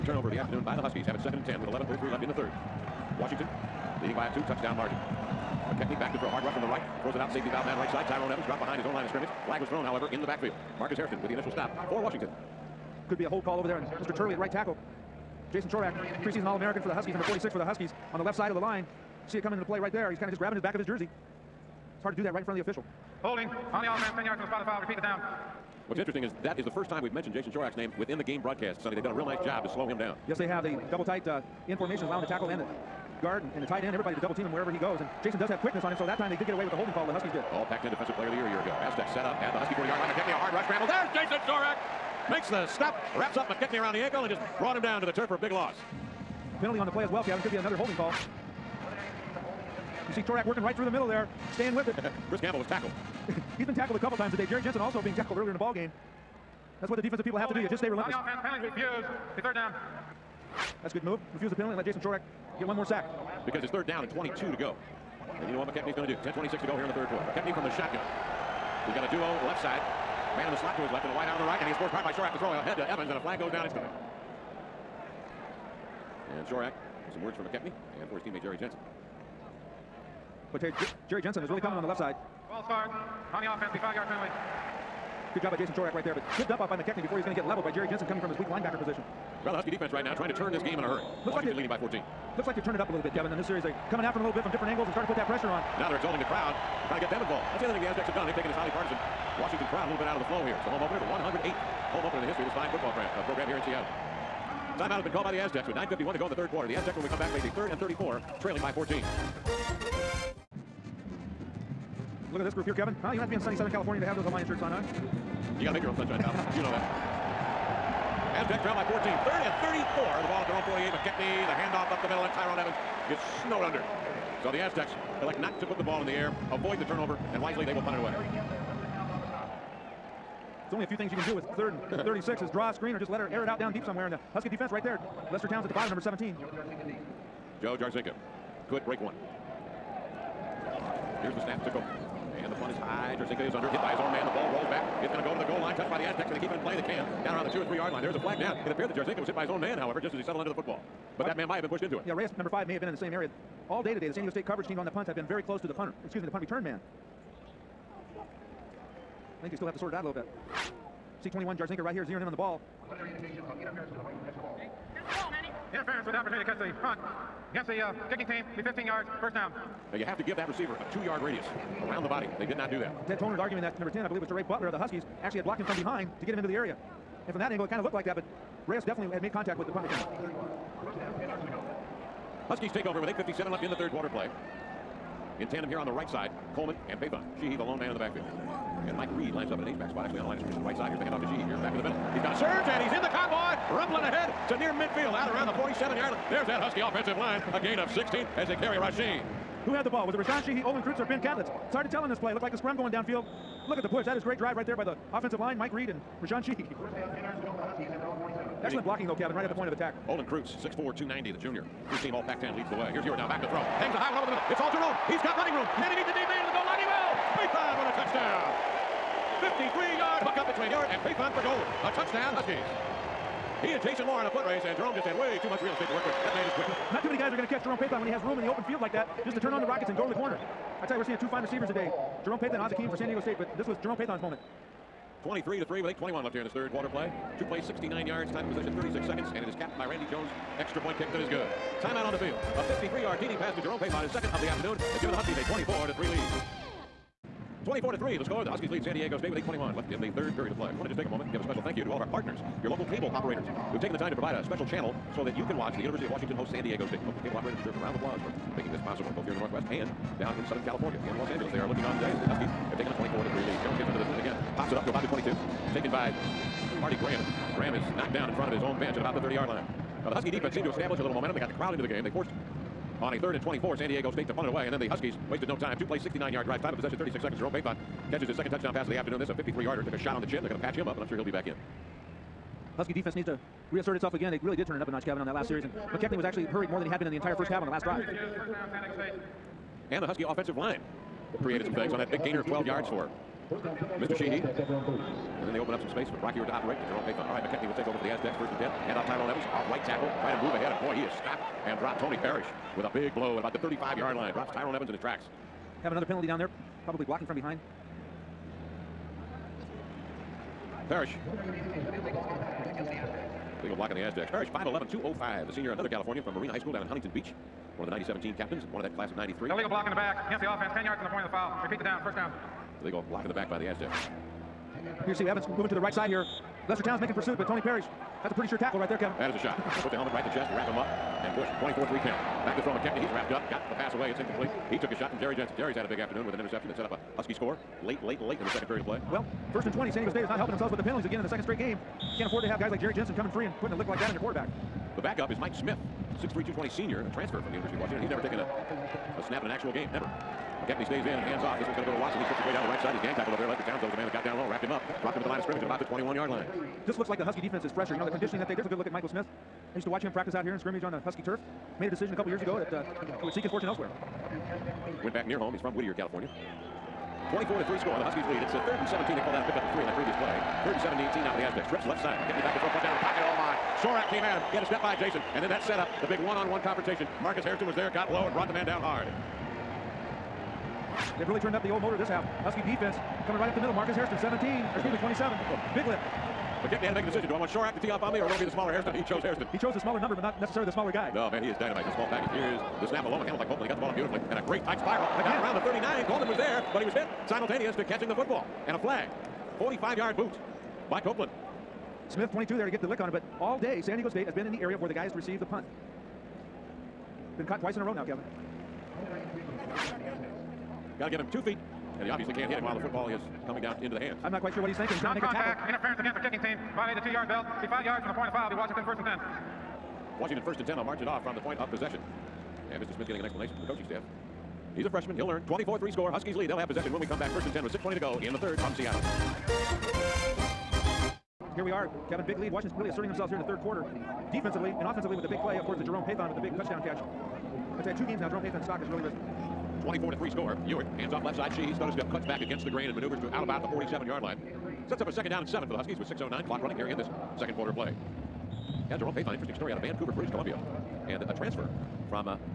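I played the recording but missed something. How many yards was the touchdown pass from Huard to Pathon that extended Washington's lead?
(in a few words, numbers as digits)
53.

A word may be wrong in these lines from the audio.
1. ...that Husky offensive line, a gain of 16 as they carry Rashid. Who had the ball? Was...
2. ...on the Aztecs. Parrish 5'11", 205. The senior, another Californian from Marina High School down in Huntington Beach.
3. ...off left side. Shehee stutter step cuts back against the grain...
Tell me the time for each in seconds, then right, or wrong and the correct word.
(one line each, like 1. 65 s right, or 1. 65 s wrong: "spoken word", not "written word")
1. 196 s right
2. 313 s right
3. 441 s right.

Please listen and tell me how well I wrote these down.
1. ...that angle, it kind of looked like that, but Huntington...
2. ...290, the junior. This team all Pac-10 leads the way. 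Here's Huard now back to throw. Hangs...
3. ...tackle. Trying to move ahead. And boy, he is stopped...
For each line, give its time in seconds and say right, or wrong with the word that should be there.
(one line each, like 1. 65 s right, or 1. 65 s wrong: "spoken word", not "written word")
1. 177 s wrong: "Reyes", not "Huntington"
2. 210 s right
3. 299 s right.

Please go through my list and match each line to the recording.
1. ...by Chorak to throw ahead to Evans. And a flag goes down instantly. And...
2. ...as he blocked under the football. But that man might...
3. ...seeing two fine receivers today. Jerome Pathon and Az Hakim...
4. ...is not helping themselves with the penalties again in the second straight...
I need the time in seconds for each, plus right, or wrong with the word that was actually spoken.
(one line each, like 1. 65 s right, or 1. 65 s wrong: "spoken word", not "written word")
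1. 72 s right
2. 150 s wrong: "settled", not "blocked"
3. 231 s right
4. 340 s right.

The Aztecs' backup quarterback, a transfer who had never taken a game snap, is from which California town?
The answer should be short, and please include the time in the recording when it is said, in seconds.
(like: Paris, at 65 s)
Whittier, at 365 s.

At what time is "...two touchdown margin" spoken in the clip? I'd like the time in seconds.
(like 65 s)
4 s.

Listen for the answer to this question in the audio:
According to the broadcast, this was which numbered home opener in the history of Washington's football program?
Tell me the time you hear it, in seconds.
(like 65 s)
101 s.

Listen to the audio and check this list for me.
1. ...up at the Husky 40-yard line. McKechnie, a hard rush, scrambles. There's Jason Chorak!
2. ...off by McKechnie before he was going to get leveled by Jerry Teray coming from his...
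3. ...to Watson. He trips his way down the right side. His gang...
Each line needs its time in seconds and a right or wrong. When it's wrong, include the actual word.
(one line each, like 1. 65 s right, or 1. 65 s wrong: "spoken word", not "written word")
1. 39 s right
2. 86 s wrong: "Jensen", not "Teray"
3. 351 s right.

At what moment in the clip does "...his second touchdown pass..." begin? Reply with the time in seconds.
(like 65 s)
278 s.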